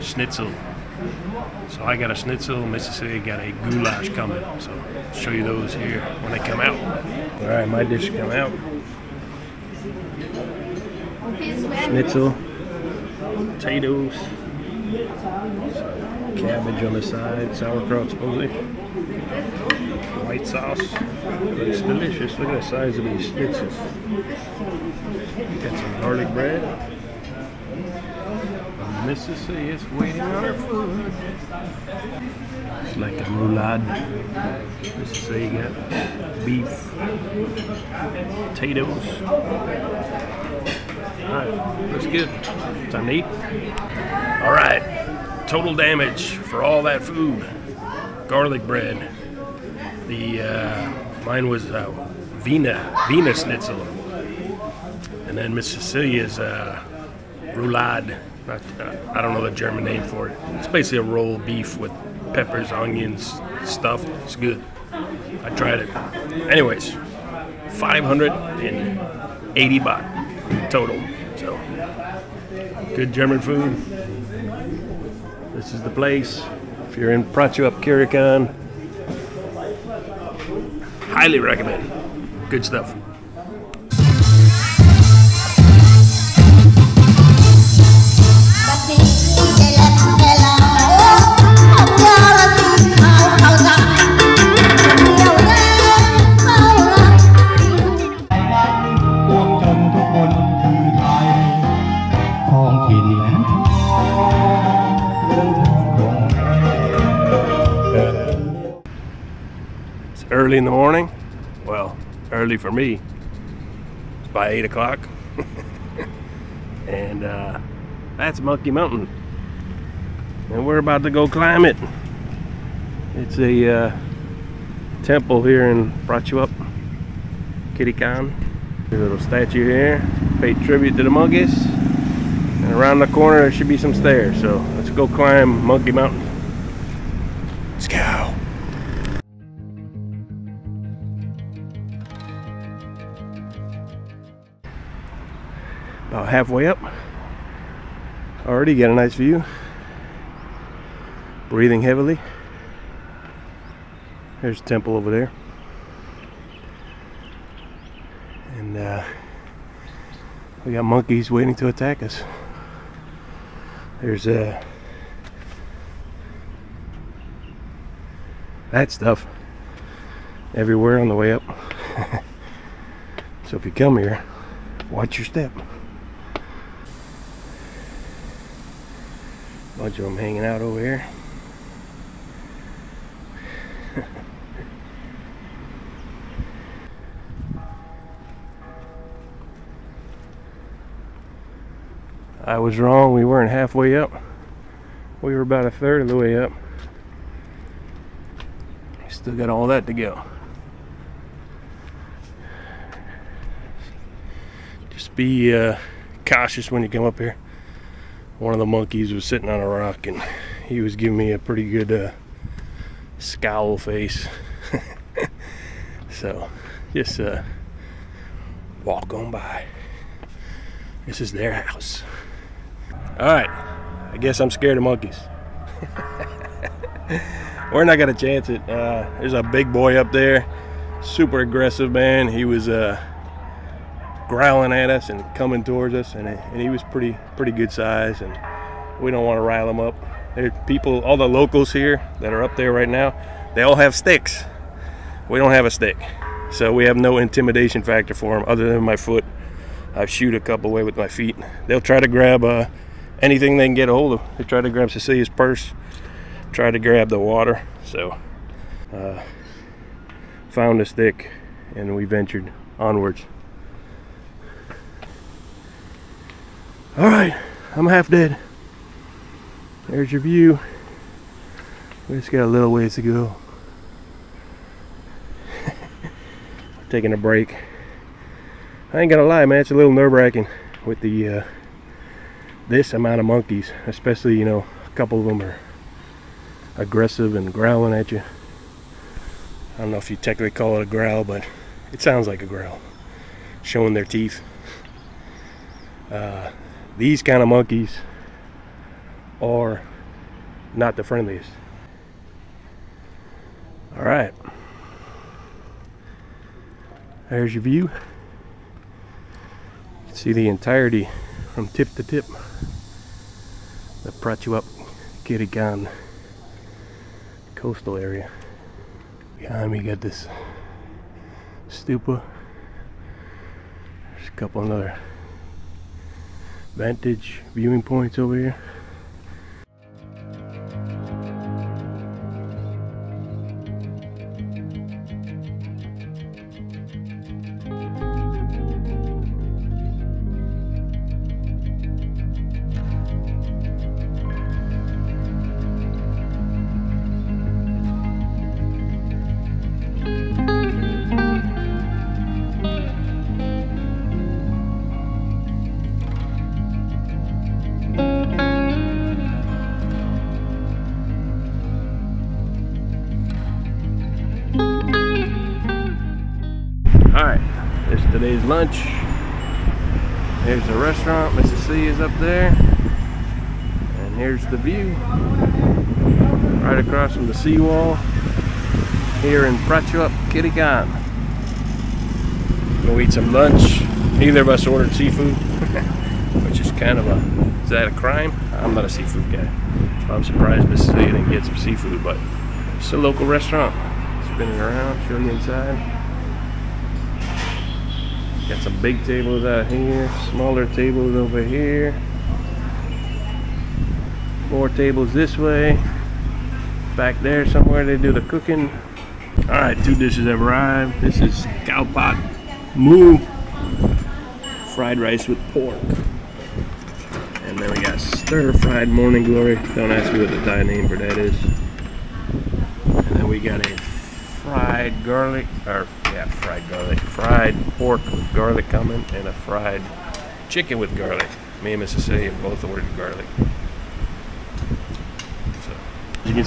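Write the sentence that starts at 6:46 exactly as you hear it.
Back there somewhere they do the cooking.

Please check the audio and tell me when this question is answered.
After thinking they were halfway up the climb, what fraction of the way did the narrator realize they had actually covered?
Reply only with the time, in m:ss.
3:15.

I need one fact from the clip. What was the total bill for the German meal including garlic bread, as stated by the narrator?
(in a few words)
580 baht.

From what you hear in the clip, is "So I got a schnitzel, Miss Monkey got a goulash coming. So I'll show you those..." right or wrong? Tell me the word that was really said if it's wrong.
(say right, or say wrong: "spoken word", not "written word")
wrong: "Cecilia", not "Monkey".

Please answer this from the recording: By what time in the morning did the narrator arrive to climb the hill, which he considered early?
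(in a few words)
8 o'clock.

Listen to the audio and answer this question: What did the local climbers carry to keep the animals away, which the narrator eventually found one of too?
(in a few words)
Sticks.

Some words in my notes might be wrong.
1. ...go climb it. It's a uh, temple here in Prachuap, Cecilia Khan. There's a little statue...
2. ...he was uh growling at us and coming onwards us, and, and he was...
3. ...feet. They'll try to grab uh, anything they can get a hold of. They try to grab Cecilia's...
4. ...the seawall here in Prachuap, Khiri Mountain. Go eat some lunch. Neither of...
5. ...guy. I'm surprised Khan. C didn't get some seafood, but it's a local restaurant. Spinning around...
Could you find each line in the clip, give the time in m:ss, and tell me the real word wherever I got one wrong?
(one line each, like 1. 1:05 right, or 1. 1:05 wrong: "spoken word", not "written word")
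1. 2:01 wrong: "Khiri", not "Cecilia"
2. 3:52 wrong: "towards", not "onwards"
3. 4:11 right
4. 6:17 wrong: "Khan", not "Mountain"
5. 6:29 wrong: "Mrs", not "Khan".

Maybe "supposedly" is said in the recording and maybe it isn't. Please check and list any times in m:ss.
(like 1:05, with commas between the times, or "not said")
0:18.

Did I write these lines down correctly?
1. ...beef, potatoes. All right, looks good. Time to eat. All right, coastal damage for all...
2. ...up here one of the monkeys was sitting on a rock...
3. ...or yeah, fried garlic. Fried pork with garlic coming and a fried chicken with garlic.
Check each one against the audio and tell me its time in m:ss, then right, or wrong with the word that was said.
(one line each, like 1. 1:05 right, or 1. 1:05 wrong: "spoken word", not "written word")
1. 0:36 wrong: "total", not "coastal"
2. 3:27 right
3. 7:05 right.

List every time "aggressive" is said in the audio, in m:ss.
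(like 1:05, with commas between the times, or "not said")
3:51, 4:46.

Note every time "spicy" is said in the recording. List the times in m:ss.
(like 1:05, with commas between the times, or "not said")
not said.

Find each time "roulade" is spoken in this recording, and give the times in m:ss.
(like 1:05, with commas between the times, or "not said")
0:33, 0:57.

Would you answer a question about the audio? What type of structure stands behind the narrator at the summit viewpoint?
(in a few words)
Stupa.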